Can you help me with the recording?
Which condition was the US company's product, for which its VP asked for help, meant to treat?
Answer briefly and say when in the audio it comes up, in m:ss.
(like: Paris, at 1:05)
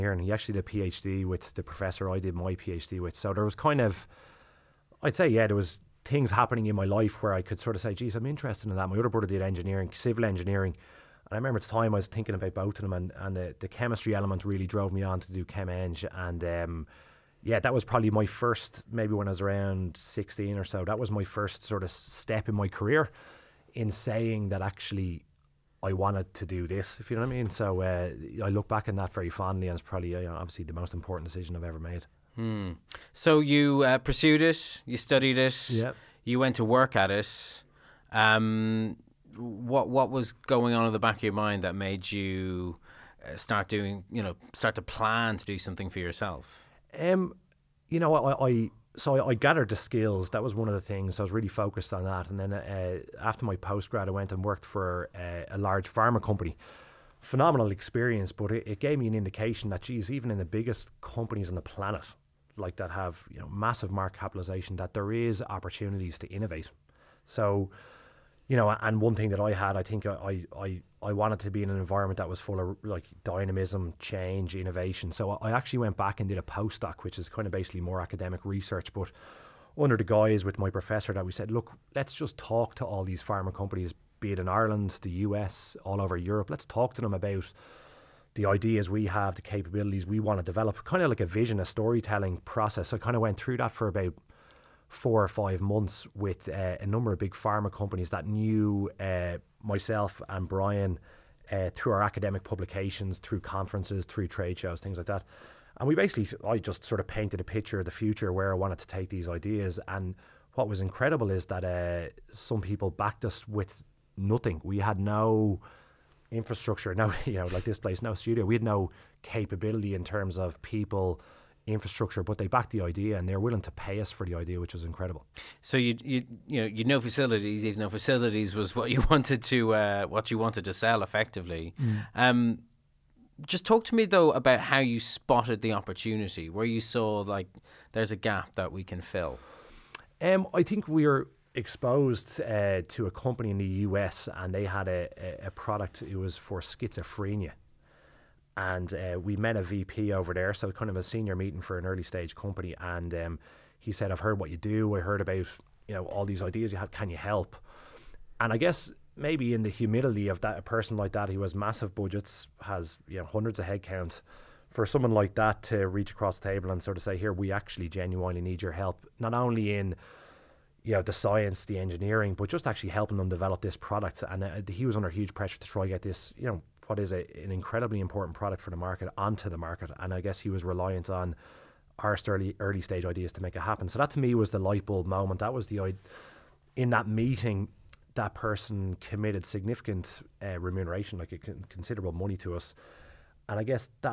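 schizophrenia, at 2:26.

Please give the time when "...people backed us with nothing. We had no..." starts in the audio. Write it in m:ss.
1:52.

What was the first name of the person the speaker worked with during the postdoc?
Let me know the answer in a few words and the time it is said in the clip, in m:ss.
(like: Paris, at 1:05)
Brian, at 1:40.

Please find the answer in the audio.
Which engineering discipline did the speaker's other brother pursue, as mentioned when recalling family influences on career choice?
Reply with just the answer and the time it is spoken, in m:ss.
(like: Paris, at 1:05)
civil engineering, at 0:09.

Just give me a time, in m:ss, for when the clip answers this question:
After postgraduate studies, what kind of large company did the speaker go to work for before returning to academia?
0:55.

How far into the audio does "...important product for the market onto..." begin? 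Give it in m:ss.
2:58.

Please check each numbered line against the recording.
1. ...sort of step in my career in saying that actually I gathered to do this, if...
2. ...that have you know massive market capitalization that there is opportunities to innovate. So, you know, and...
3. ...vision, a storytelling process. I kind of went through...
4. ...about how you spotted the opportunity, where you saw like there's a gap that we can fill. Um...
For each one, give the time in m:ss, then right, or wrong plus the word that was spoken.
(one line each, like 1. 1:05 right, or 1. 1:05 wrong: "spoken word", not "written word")
1. 0:21 wrong: "wanted", not "gathered"
2. 1:02 right
3. 1:31 right
4. 2:14 right.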